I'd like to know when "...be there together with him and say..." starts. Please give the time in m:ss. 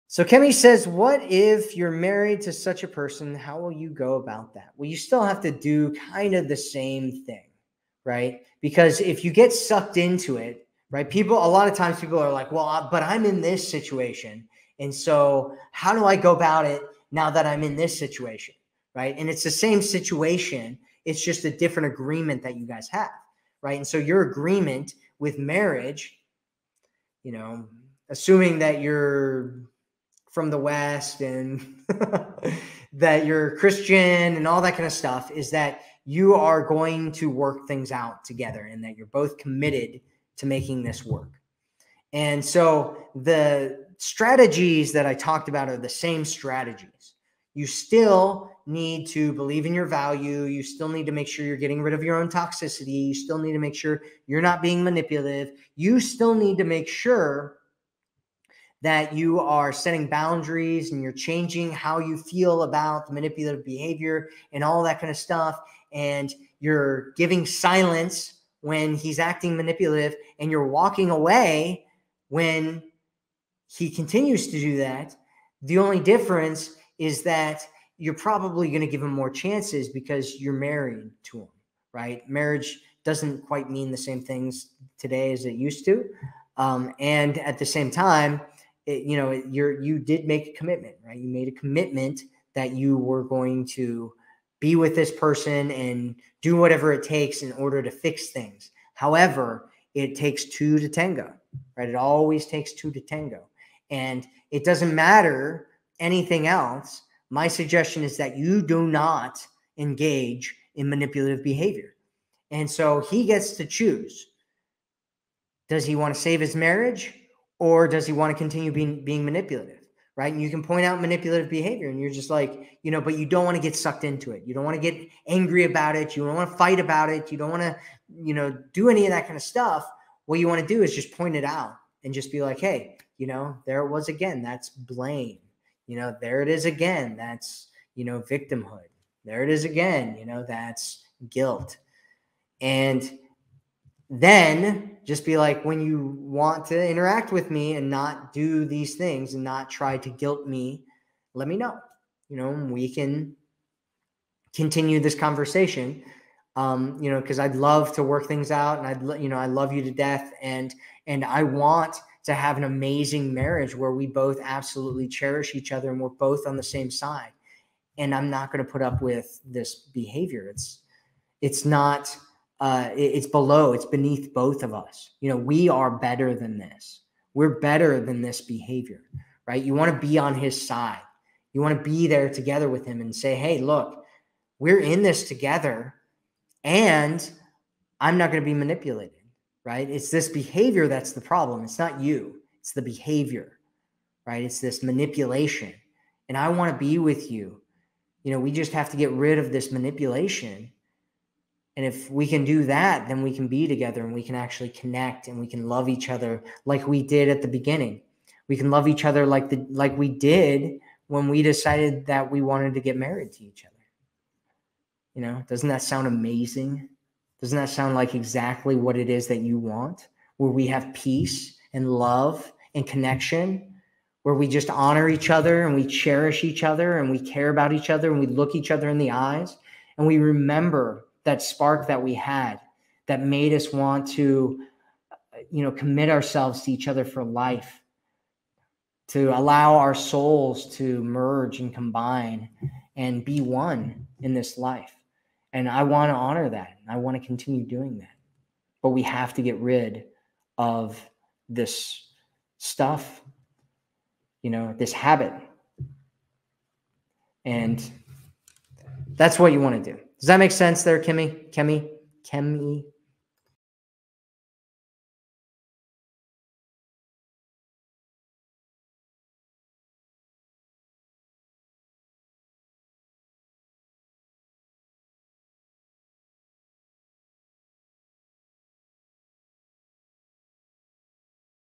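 3:01.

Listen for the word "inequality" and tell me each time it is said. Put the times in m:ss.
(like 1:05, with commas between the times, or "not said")
not said.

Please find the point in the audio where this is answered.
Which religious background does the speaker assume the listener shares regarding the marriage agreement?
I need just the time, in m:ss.
0:33.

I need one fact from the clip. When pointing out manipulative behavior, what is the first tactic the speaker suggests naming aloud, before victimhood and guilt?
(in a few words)
Blame.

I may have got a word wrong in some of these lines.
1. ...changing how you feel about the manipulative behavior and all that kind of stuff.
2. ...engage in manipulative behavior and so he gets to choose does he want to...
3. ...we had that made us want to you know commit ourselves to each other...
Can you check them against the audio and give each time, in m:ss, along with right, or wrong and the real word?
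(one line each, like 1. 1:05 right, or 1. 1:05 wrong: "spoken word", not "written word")
1. 1:01 right
2. 1:49 right
3. 3:52 right.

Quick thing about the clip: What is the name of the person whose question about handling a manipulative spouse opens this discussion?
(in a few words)
Kemi.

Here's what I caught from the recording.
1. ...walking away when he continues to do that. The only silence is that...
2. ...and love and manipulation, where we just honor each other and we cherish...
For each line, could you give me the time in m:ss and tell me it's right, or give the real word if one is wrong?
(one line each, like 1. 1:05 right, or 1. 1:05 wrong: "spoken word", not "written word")
1. 1:10 wrong: "difference", not "silence"
2. 3:41 wrong: "connection", not "manipulation".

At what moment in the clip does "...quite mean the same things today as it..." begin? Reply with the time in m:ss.
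1:23.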